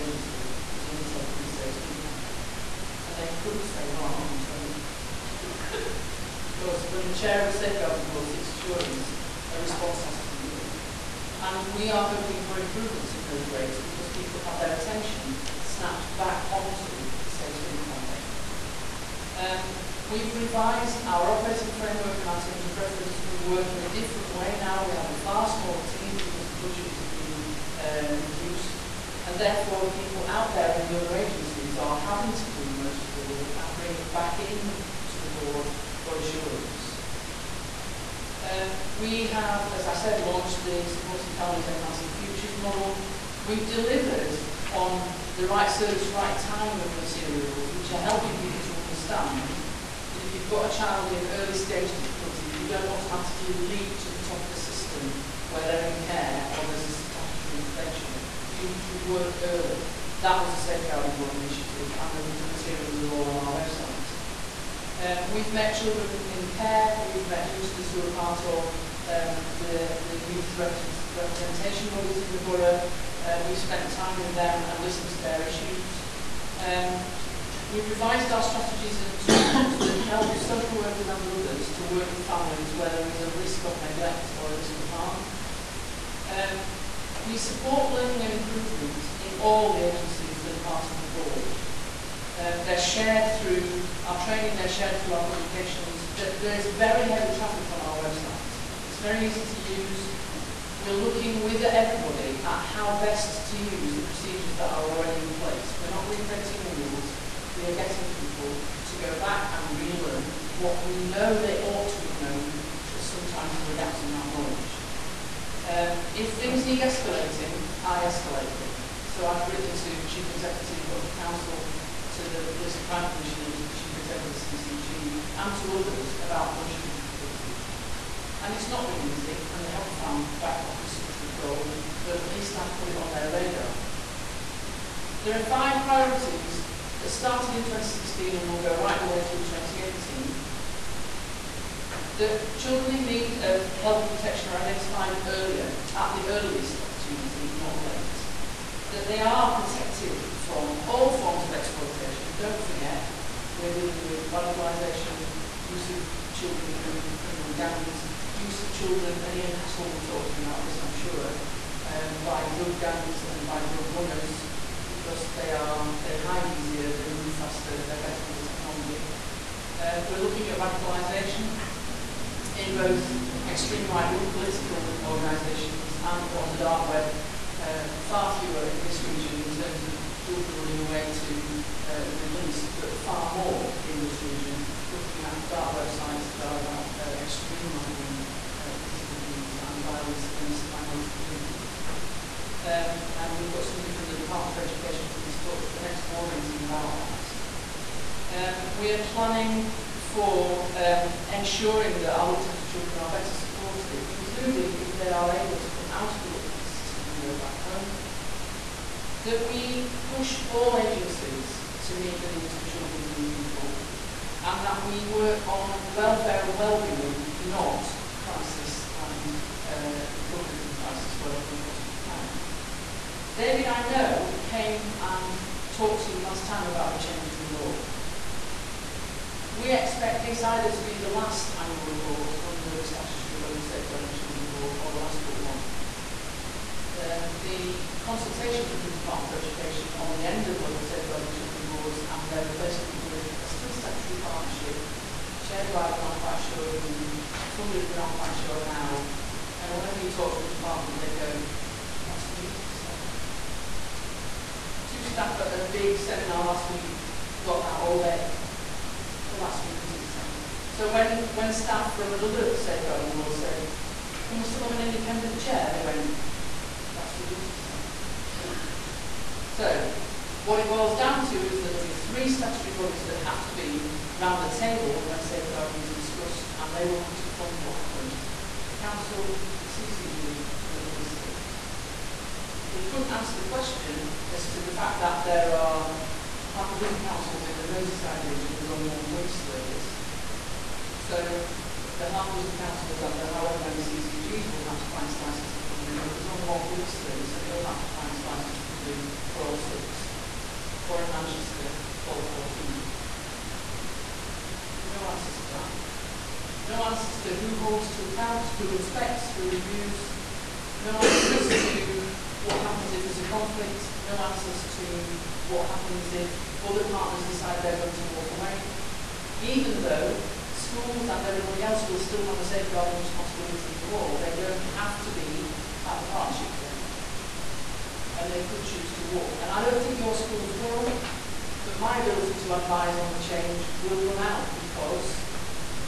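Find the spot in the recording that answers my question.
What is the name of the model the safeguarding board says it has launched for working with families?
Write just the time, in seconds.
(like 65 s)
40 s.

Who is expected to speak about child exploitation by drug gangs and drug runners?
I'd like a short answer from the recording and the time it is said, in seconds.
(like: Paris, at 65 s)
Ian Hassel, at 159 s.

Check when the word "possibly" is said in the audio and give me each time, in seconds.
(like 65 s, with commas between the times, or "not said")
221 s.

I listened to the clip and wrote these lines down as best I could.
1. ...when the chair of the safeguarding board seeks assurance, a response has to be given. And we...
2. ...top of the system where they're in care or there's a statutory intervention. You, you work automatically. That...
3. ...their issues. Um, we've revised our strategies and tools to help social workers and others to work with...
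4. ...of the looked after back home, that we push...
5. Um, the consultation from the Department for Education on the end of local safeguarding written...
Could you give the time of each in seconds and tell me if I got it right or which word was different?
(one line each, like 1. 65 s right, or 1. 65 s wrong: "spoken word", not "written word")
1. 6 s right
2. 54 s wrong: "early", not "automatically"
3. 75 s right
4. 206 s right
5. 236 s wrong: "children", not "written".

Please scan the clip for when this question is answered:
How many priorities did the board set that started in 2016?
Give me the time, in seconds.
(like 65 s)
135 s.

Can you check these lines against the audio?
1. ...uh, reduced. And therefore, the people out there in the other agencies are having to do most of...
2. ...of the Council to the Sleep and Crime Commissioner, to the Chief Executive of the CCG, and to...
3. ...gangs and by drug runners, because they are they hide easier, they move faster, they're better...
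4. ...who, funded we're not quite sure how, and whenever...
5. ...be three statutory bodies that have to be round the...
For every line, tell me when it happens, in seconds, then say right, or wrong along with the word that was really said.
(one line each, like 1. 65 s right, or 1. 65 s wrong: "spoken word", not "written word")
1. 27 s right
2. 120 s wrong: "Police", not "Sleep"
3. 162 s right
4. 246 s right
5. 271 s right.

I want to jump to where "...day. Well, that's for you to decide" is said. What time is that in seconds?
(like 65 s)
258 s.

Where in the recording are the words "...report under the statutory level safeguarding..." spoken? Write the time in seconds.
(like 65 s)
231 s.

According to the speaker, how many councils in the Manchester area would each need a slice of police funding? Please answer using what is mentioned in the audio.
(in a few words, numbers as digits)
14.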